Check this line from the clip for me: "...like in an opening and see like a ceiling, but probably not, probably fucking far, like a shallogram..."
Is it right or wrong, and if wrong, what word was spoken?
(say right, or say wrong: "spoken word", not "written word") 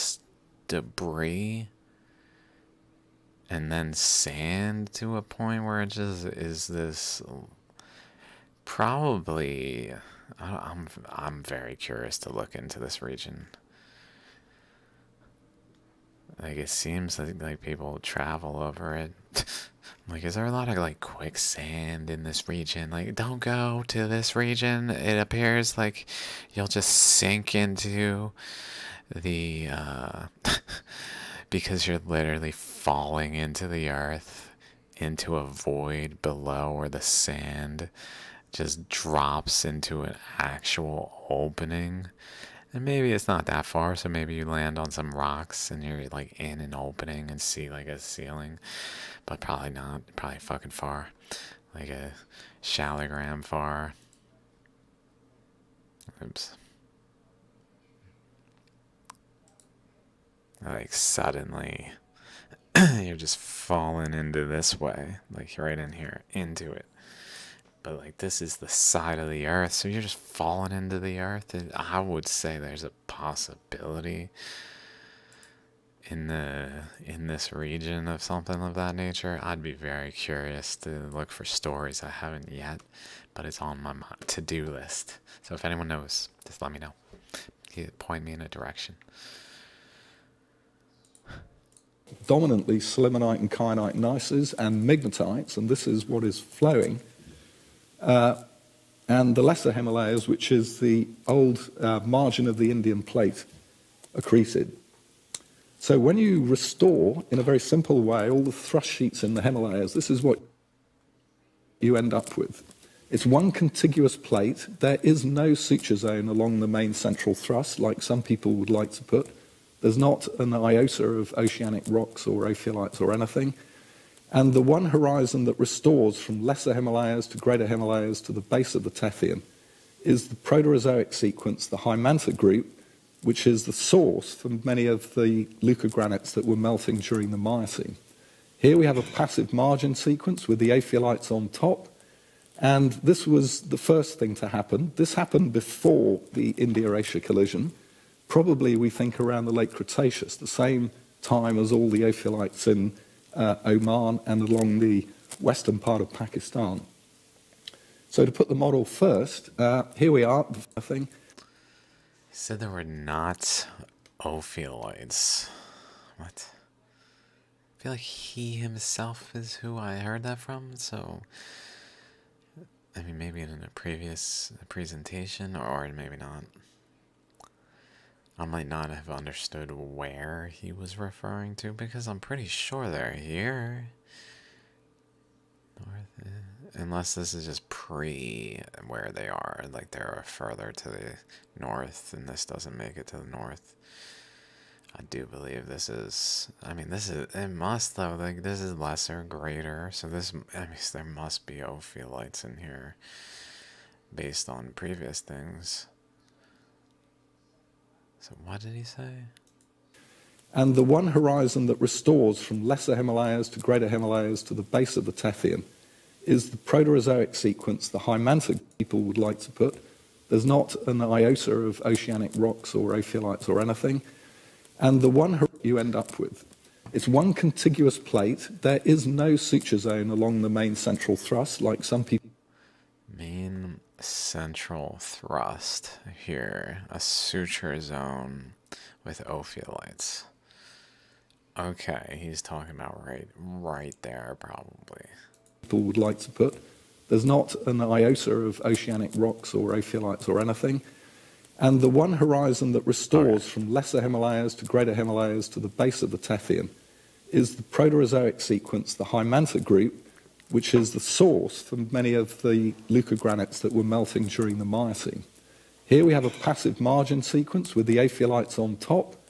right.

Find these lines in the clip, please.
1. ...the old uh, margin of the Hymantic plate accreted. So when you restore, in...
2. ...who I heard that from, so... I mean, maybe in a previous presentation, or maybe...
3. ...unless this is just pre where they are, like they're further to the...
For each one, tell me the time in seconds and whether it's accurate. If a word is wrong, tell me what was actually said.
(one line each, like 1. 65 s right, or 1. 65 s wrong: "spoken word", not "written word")
1. 100 s wrong: "Indian", not "Hymantic"
2. 169 s right
3. 186 s right.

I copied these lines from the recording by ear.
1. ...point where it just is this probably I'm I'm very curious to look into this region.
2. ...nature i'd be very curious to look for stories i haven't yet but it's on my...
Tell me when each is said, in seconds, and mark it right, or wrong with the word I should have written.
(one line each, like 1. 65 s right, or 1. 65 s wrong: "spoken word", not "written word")
1. 5 s right
2. 78 s right.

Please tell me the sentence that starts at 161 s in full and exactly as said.
He said there were not Ophiolites.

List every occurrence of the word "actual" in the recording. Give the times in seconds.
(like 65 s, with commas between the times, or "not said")
40 s.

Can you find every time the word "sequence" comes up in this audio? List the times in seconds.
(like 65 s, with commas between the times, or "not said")
131 s, 139 s, 217 s, 258 s, 267 s.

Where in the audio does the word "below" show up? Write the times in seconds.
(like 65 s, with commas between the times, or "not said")
36 s.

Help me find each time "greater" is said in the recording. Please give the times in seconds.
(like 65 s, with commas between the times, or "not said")
127 s, 199 s, 213 s, 254 s.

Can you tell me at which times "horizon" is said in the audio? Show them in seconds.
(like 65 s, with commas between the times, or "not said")
124 s, 211 s, 252 s.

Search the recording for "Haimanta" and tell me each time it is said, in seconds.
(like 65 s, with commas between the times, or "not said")
131 s, 259 s.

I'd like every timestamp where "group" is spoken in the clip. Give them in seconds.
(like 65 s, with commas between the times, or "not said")
132 s, 259 s.